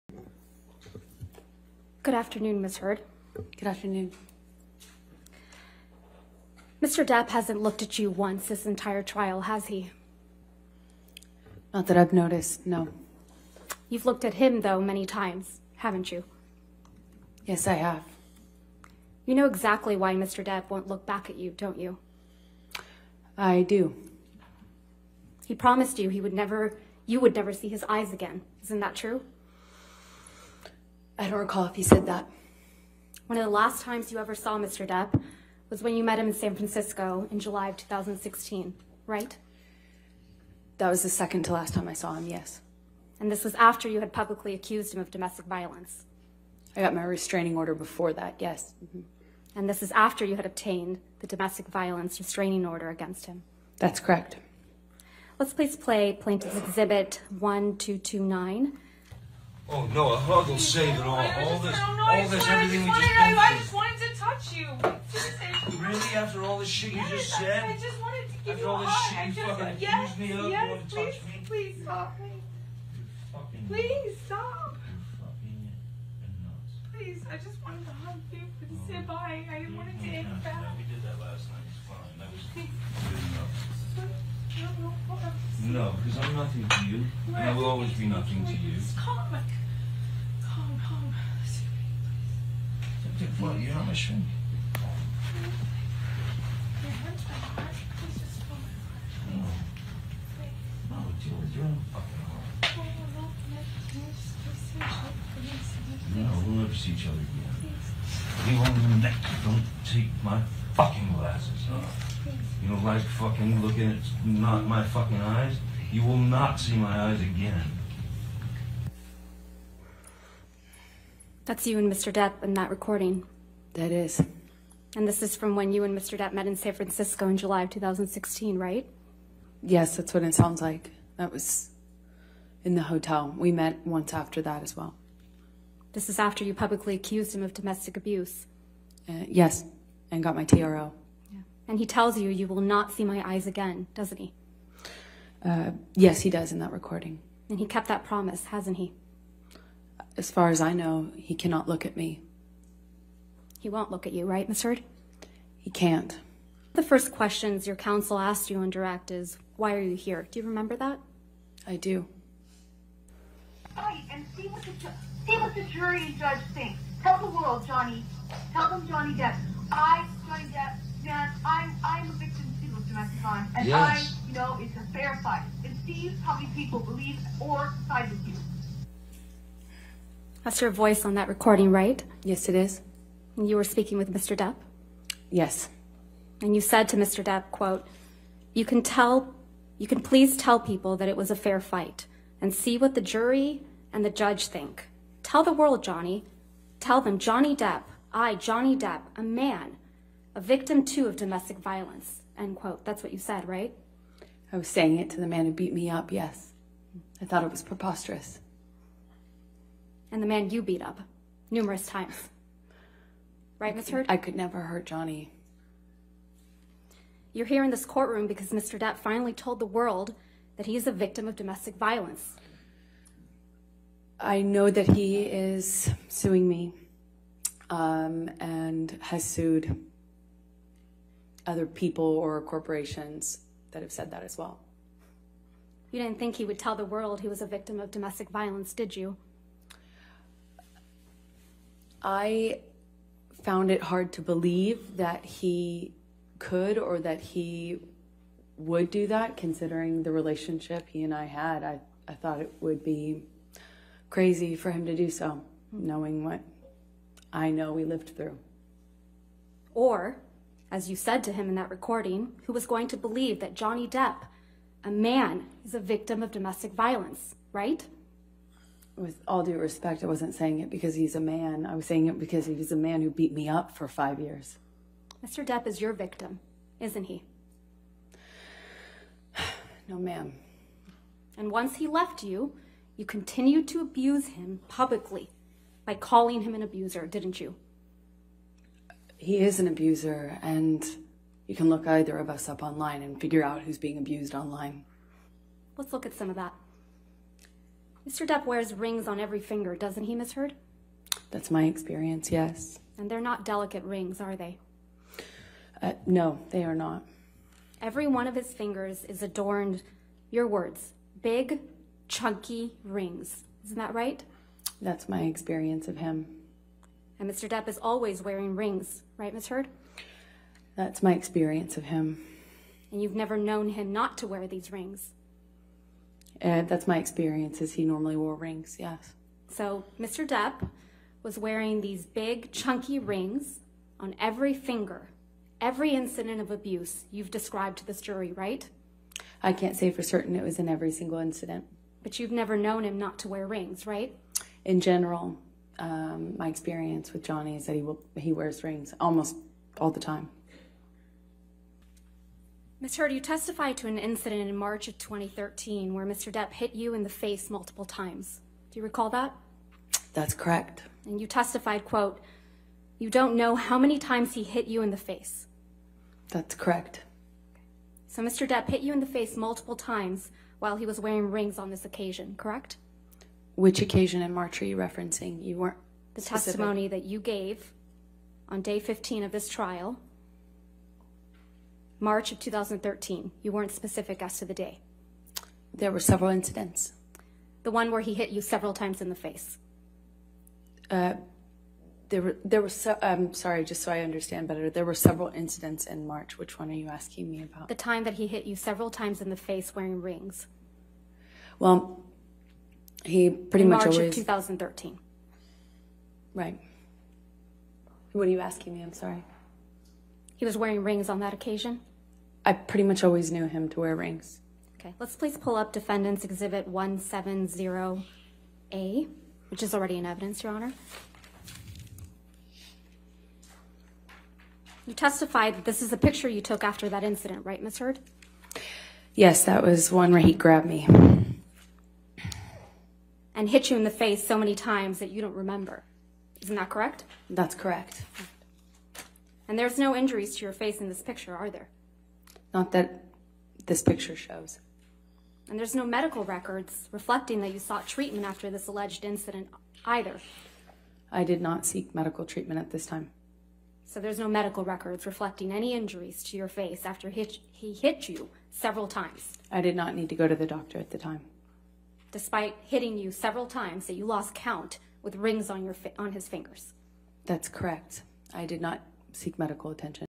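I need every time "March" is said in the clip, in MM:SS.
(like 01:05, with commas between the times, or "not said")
05:54, 06:14, 06:21, 06:36, 06:43.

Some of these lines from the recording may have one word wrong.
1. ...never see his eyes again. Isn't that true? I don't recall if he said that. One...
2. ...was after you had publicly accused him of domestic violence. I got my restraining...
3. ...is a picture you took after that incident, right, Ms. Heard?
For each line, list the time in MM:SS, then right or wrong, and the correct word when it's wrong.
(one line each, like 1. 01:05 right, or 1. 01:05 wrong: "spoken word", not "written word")
1. 00:27 right
2. 00:43 right
3. 07:05 right.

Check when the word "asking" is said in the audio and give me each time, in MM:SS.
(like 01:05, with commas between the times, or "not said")
06:36, 06:48.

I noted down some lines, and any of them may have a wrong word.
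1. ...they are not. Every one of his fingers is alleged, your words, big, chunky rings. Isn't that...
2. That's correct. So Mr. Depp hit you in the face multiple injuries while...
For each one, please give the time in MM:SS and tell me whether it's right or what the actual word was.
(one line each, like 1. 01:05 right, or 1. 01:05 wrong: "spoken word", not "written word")
1. 05:06 wrong: "adorned", not "alleged"
2. 06:06 wrong: "times", not "injuries".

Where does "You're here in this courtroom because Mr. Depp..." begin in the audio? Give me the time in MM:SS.
03:37.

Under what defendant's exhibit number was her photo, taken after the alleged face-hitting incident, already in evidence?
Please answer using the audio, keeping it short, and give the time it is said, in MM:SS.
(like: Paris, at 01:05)
Defendant's Exhibit 170A, at 06:55.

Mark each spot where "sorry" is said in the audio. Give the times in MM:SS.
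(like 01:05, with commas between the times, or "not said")
06:33, 06:48.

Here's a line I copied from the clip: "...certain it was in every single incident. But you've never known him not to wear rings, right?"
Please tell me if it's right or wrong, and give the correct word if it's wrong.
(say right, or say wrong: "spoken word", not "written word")
right.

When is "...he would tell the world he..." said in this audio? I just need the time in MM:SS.
03:56.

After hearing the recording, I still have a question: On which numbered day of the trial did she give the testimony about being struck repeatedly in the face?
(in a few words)
Day 15.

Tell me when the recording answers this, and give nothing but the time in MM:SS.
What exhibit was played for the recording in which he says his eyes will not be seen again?
00:56.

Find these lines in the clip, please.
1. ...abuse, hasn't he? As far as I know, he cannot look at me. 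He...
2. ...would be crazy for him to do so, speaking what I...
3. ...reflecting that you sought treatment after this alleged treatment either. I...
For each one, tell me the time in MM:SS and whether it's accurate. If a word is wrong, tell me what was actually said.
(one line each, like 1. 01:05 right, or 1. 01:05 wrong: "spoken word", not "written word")
1. 02:28 wrong: "promise", not "abuse"
2. 04:12 wrong: "knowing", not "speaking"
3. 07:26 wrong: "incident", not "treatment".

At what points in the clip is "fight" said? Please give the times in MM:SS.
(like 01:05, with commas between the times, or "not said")
02:55, 03:11.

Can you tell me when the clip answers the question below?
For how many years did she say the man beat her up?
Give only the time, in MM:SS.
04:33.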